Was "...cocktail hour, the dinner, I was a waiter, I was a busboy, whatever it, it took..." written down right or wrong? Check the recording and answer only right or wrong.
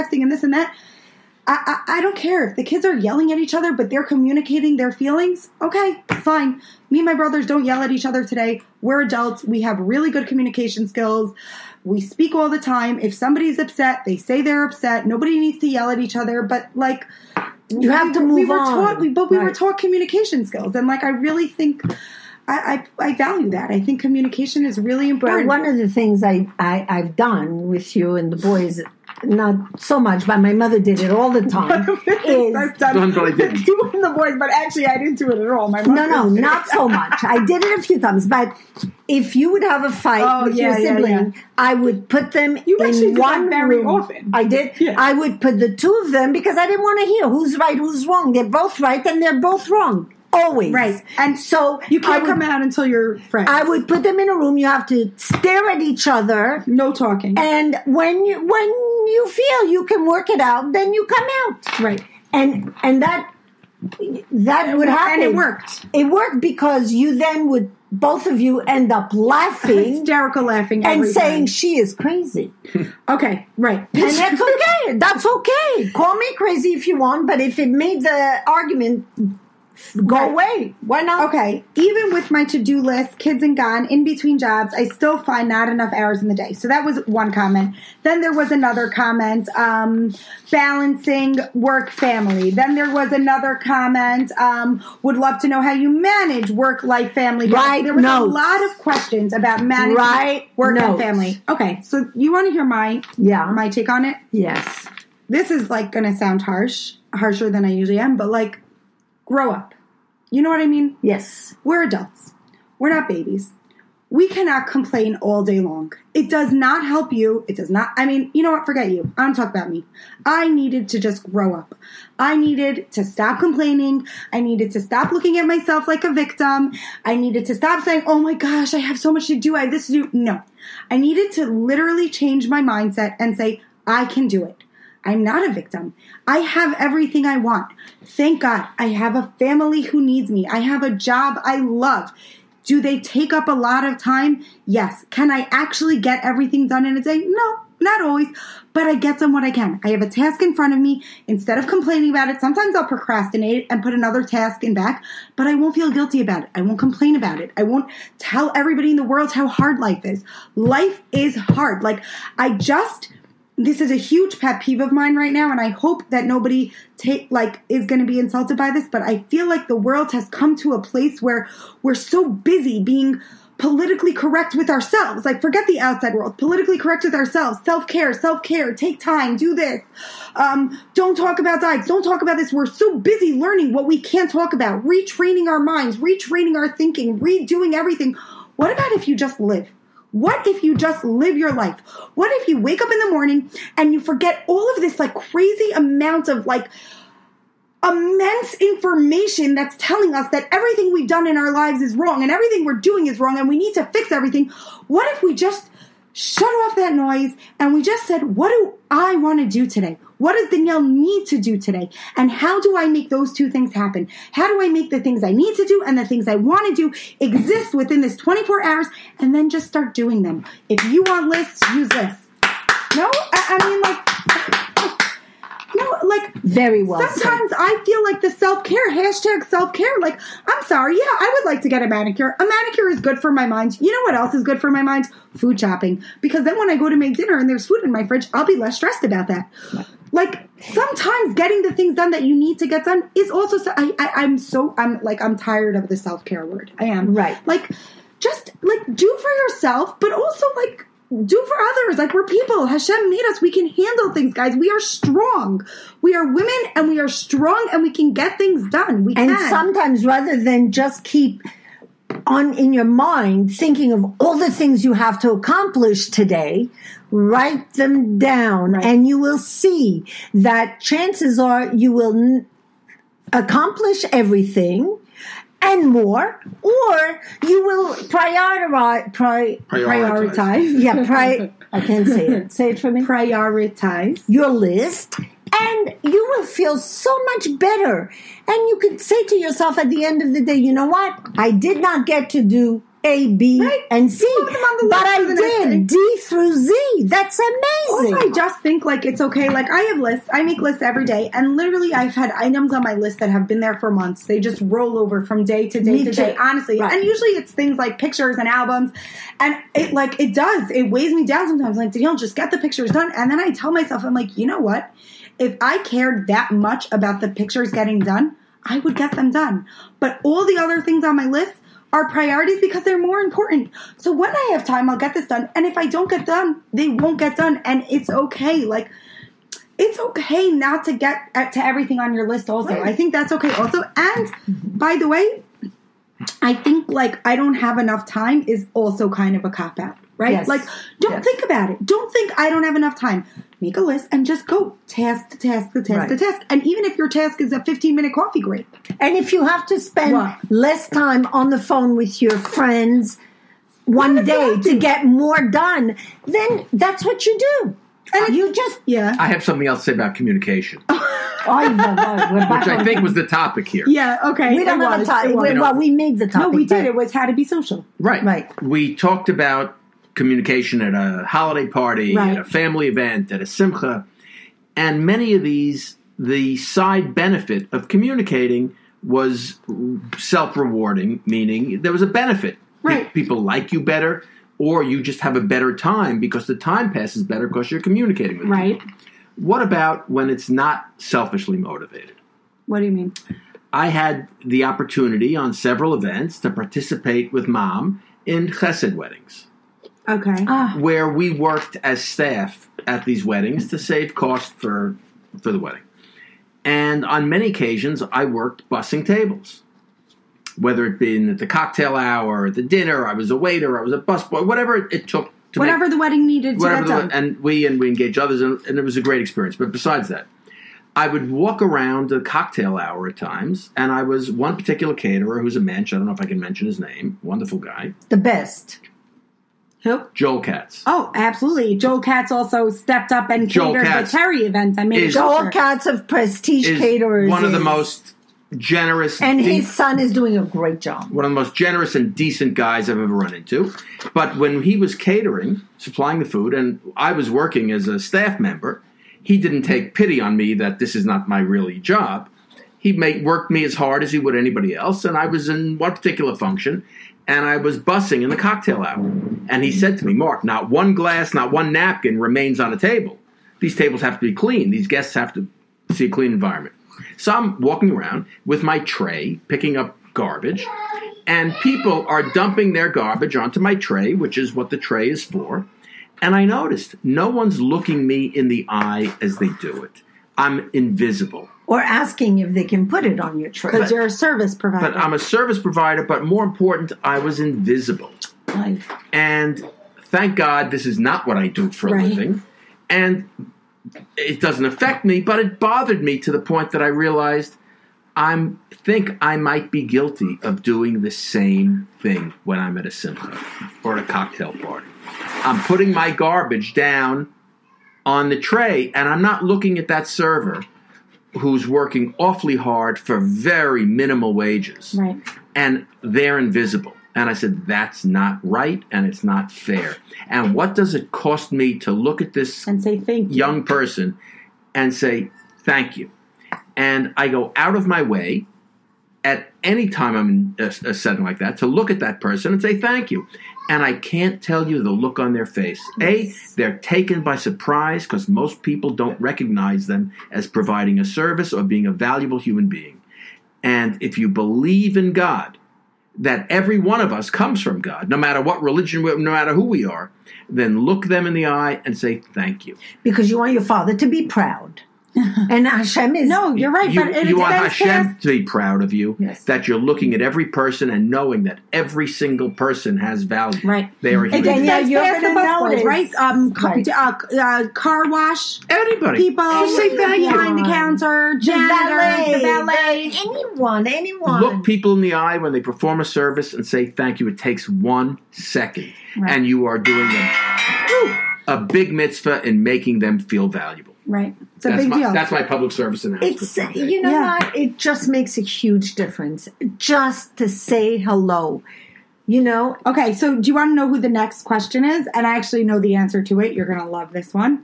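right.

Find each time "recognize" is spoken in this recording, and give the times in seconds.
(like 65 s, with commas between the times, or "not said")
539 s.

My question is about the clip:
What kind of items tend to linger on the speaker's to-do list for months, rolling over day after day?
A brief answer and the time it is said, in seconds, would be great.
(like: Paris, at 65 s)
Pictures and albums, at 307 s.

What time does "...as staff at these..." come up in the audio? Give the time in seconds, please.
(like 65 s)
401 s.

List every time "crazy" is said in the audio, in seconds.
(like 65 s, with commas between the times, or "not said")
71 s, 76 s, 195 s.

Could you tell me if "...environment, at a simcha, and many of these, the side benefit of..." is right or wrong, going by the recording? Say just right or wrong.
wrong.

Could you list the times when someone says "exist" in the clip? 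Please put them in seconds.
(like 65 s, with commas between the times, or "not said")
217 s.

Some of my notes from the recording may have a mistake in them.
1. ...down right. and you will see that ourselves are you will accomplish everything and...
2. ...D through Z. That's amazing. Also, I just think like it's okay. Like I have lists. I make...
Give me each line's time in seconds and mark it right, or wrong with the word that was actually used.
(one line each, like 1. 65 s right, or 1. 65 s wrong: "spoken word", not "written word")
1. 268 s wrong: "chances", not "ourselves"
2. 295 s right.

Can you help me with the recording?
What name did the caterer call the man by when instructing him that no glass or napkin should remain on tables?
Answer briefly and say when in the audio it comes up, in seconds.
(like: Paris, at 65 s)
Mark, at 460 s.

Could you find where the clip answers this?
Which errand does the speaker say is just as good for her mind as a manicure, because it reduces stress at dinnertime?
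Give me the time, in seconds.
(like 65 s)
235 s.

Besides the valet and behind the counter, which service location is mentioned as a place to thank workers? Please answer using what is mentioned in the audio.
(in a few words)
Car wash.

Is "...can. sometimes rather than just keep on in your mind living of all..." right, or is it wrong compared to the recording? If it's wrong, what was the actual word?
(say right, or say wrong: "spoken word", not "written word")
wrong: "thinking", not "living".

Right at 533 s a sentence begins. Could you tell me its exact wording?
And I can't tell you the look on their face.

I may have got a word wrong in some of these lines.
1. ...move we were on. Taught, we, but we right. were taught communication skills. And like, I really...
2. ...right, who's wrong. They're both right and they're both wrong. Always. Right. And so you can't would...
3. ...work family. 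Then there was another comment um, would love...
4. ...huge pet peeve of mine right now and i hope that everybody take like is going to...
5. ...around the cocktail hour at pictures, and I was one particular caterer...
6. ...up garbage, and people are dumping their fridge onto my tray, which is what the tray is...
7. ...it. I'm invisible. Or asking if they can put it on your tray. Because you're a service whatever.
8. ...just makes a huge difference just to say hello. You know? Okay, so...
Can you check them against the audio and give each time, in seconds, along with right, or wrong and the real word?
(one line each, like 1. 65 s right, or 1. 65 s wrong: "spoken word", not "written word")
1. 18 s right
2. 47 s right
3. 91 s right
4. 163 s wrong: "nobody", not "everybody"
5. 421 s wrong: "times", not "pictures"
6. 469 s wrong: "garbage", not "fridge"
7. 479 s wrong: "provider", not "whatever"
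8. 587 s right.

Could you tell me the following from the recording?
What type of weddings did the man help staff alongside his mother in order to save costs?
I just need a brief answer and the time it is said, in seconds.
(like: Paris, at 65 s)
Chesed weddings, at 398 s.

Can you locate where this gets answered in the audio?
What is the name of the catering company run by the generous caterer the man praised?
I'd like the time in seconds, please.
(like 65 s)
436 s.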